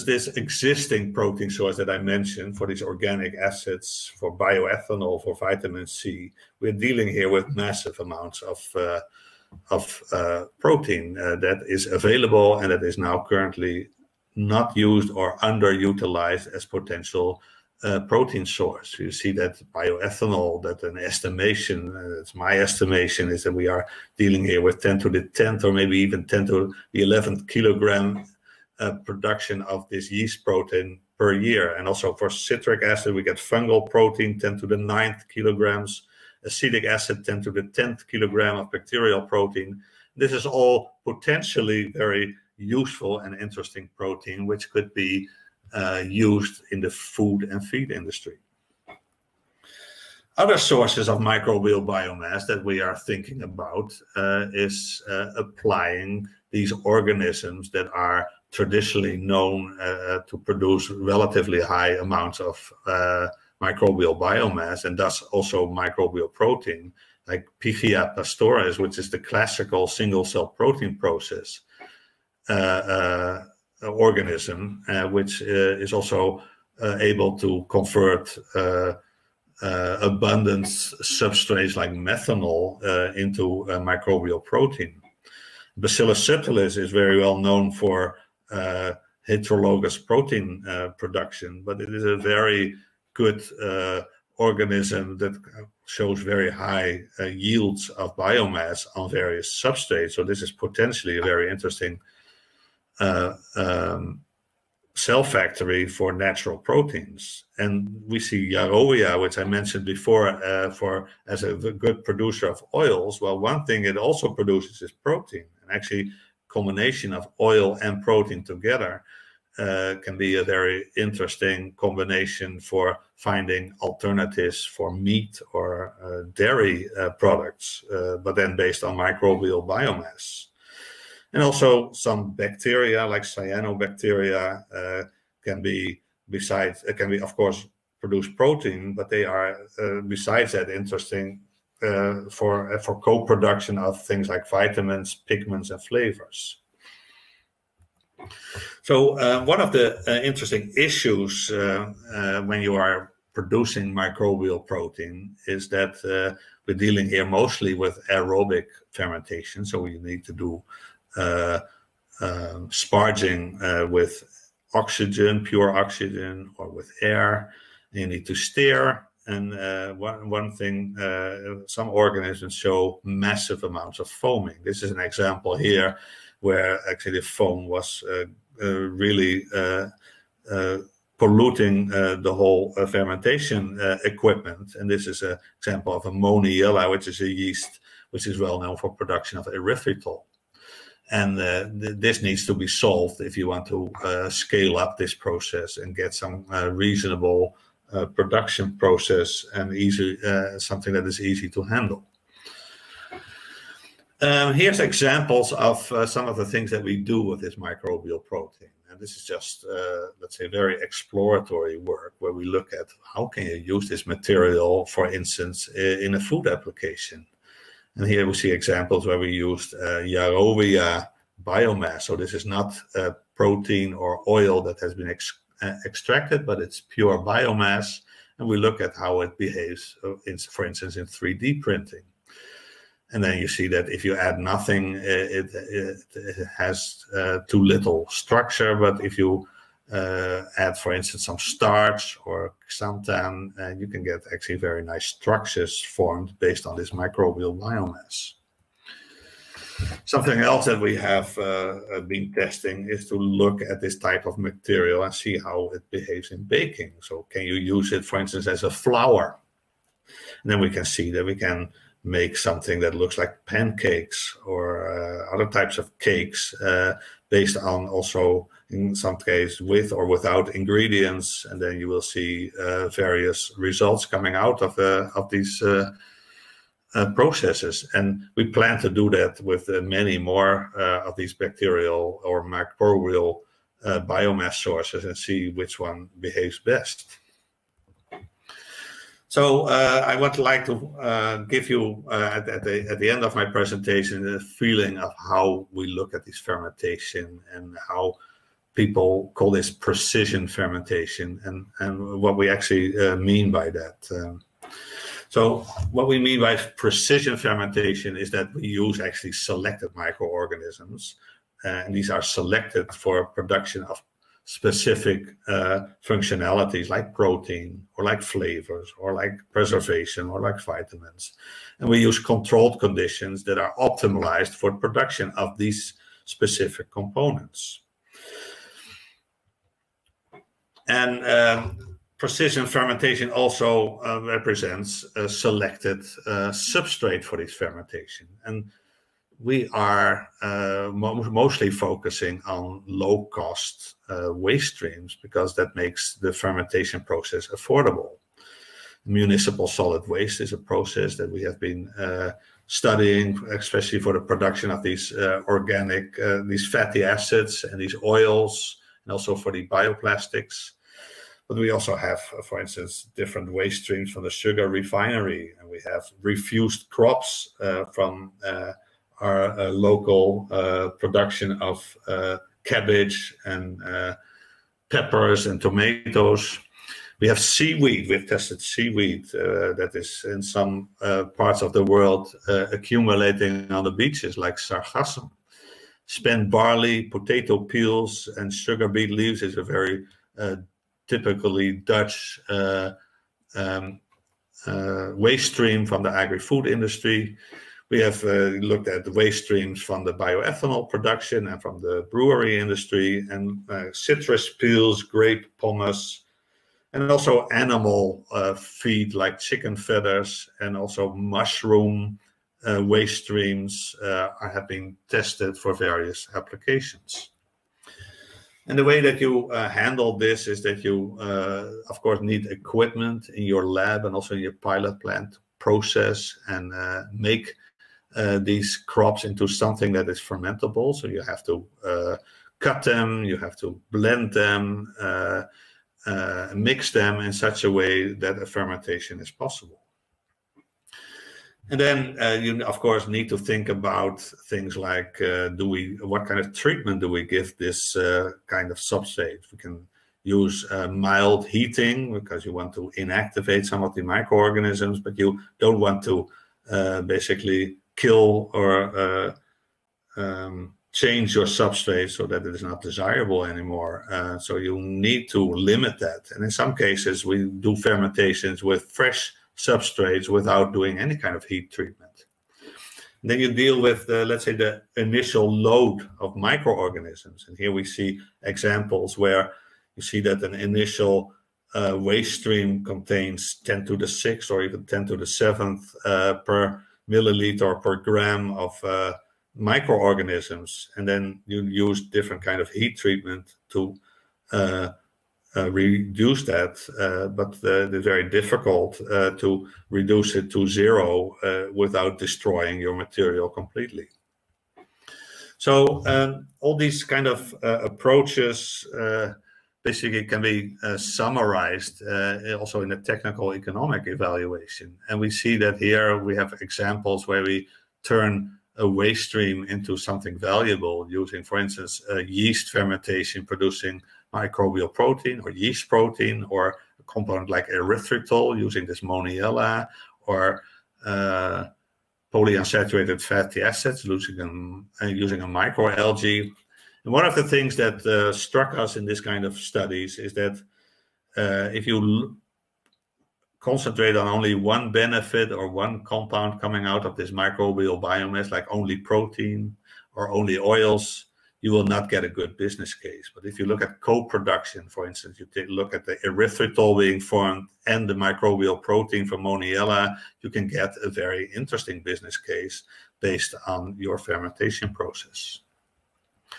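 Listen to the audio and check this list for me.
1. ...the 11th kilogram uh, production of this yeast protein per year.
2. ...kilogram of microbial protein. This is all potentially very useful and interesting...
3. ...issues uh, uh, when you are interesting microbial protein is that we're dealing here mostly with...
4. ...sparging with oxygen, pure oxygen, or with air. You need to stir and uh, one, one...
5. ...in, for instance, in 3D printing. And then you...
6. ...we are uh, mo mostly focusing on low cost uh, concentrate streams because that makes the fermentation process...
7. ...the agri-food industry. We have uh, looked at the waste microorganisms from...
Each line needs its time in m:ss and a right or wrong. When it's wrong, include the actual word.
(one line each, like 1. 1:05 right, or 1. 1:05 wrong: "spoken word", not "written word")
1. 0:26 right
2. 0:38 wrong: "bacterial", not "microbial"
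3. 2:30 wrong: "producing", not "interesting"
4. 2:42 right
5. 3:50 right
6. 5:39 wrong: "waste", not "concentrate"
7. 6:36 wrong: "streams", not "microorganisms".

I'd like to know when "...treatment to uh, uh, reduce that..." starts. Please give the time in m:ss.
8:12.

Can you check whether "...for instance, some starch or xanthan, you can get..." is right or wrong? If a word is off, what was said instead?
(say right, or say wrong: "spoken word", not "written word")
right.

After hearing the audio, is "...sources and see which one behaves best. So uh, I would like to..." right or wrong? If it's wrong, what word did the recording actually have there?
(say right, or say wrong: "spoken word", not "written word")
right.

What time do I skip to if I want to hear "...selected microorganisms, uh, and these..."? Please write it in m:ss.
5:09.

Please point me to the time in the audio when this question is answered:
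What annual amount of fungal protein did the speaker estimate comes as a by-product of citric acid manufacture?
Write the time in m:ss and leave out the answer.
0:34.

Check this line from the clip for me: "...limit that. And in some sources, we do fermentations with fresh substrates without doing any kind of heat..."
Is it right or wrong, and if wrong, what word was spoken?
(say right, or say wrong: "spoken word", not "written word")
wrong: "cases", not "sources".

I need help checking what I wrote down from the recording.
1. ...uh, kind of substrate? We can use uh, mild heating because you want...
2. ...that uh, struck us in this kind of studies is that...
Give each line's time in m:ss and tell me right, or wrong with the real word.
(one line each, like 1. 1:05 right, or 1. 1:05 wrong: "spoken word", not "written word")
1. 7:27 right
2. 8:57 right.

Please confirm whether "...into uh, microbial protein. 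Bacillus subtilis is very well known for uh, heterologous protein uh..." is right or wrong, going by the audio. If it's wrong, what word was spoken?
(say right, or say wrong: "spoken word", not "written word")
right.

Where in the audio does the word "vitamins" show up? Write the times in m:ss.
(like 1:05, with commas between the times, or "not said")
0:05, 2:24, 5:20.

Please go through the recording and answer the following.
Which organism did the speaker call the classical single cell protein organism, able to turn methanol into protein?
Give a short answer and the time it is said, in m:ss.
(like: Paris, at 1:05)
Pichia pastoris, at 1:07.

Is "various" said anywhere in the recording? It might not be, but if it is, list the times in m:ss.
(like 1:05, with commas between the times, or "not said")
1:39, 4:32, 6:55.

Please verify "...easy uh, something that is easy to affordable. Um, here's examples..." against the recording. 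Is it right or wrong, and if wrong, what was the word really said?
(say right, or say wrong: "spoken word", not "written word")
wrong: "handle", not "affordable".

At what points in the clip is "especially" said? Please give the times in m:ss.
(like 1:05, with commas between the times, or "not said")
5:53.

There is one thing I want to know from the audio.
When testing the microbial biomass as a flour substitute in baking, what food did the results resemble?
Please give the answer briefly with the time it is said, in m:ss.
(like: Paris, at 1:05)
pancakes, at 4:23.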